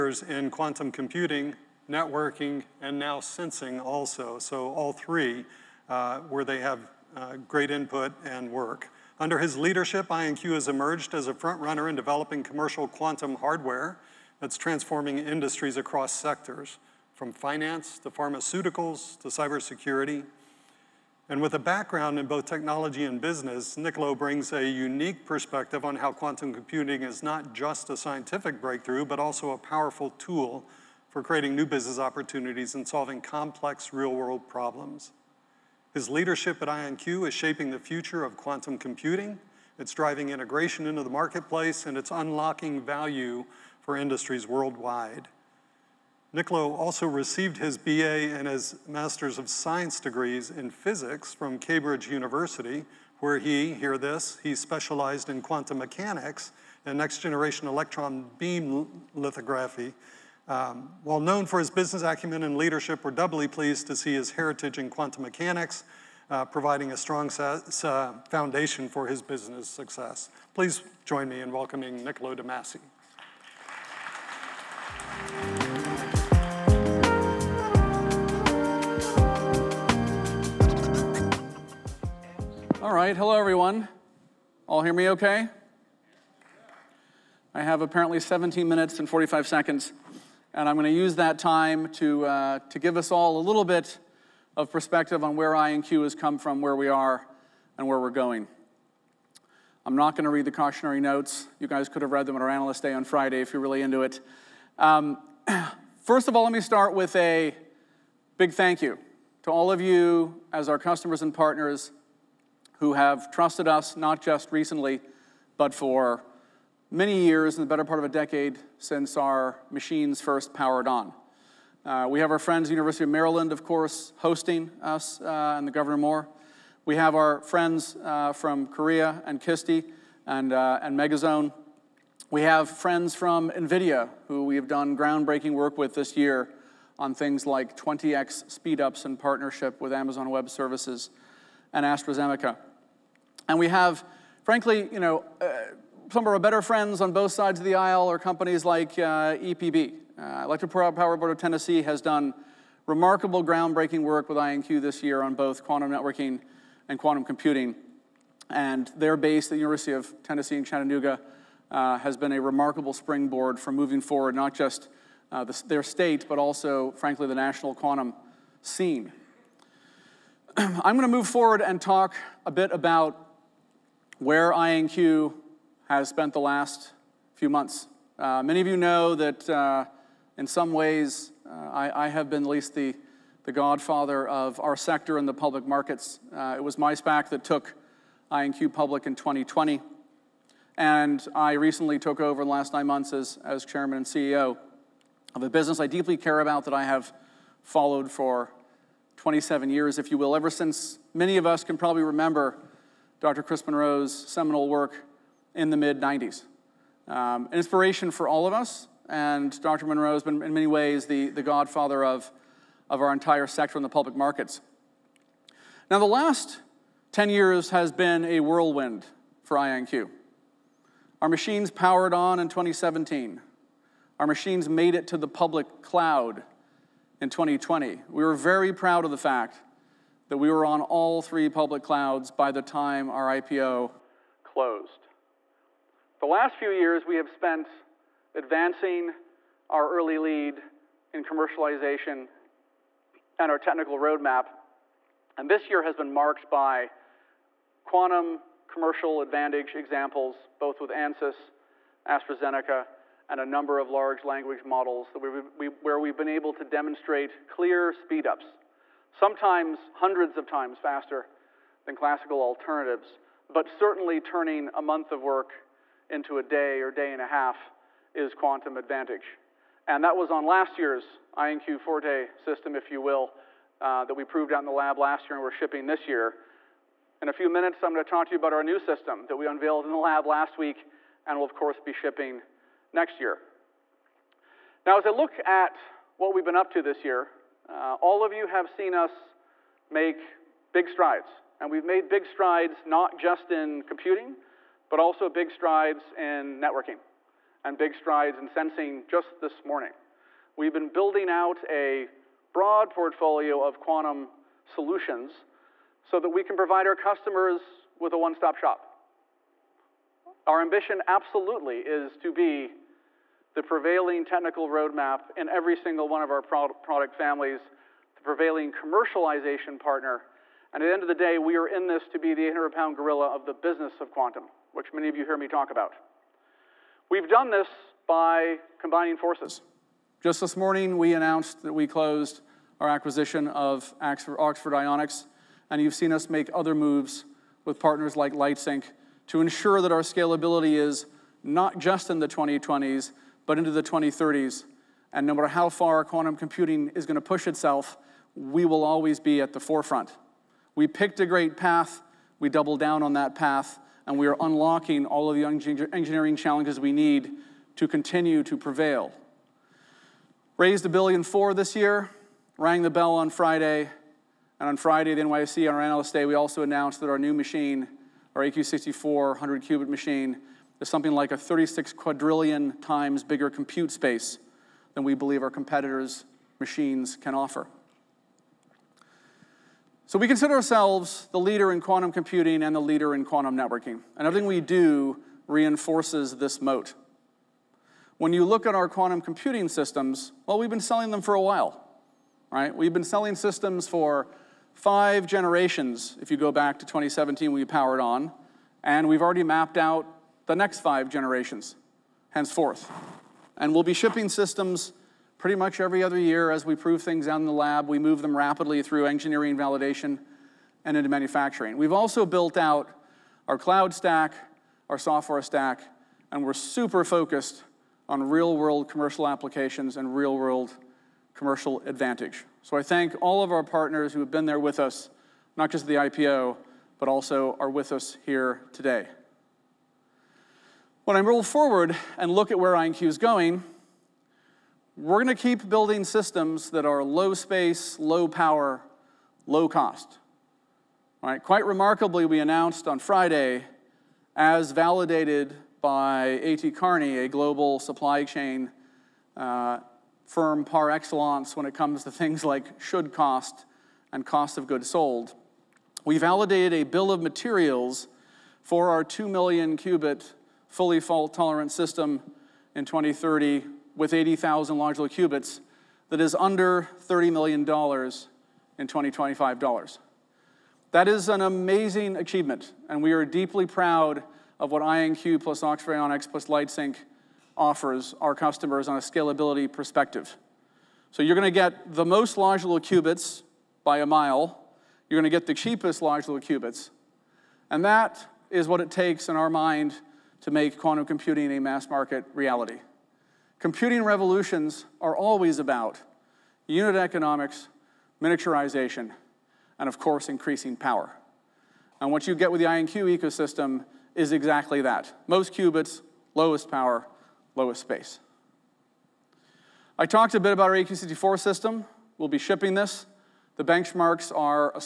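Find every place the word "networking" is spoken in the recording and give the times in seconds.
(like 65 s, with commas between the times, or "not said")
1 s, 155 s, 296 s, 383 s.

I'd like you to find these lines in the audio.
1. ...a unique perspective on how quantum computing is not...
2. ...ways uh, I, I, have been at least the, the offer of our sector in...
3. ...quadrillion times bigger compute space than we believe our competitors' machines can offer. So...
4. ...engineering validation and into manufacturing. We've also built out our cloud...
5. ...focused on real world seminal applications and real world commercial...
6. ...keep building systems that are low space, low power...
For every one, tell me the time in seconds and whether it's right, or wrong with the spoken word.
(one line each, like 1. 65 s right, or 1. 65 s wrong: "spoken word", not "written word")
1. 24 s right
2. 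180 s wrong: "godfather", not "offer"
3. 371 s right
4. 409 s right
5. 417 s wrong: "commercial", not "seminal"
6. 435 s right.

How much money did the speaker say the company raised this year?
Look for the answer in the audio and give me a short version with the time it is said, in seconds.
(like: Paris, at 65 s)
$1.4 billion, at 360 s.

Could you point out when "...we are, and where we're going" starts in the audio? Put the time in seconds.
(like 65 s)
96 s.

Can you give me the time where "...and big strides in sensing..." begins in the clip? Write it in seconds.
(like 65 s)
297 s.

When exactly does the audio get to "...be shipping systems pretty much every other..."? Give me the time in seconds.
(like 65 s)
403 s.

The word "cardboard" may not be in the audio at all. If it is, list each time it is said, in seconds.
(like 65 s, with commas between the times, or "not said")
not said.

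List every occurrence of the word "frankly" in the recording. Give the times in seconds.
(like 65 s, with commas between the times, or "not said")
144 s, 166 s.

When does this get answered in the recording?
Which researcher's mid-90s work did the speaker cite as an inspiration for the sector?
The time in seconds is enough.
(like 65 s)
203 s.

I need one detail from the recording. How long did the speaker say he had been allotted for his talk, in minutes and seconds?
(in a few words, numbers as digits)
17 minutes and 45 seconds.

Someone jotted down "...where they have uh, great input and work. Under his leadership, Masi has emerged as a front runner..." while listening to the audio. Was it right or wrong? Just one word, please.
wrong.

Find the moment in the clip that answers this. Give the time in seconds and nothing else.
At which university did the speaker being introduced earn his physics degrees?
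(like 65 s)
51 s.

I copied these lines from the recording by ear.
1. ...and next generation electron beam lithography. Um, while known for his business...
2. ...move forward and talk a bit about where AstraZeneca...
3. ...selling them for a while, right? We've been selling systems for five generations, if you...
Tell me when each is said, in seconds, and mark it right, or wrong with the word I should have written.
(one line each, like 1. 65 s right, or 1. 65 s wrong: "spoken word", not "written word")
1. 56 s right
2. 171 s wrong: "INQ", not "AstraZeneca"
3. 390 s right.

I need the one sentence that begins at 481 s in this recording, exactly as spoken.
So you're going to get the most logical qubits by a mile.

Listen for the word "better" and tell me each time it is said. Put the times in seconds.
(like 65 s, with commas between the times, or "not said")
117 s, 146 s.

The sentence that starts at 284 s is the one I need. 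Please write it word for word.
Now, as I look at what we've been up to this year, uh, all of you have seen us make big strides.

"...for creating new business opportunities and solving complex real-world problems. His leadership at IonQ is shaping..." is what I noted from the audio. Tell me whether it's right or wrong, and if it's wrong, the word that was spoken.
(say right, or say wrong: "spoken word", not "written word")
right.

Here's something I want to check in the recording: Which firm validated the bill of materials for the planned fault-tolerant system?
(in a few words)
A.T. Kearney.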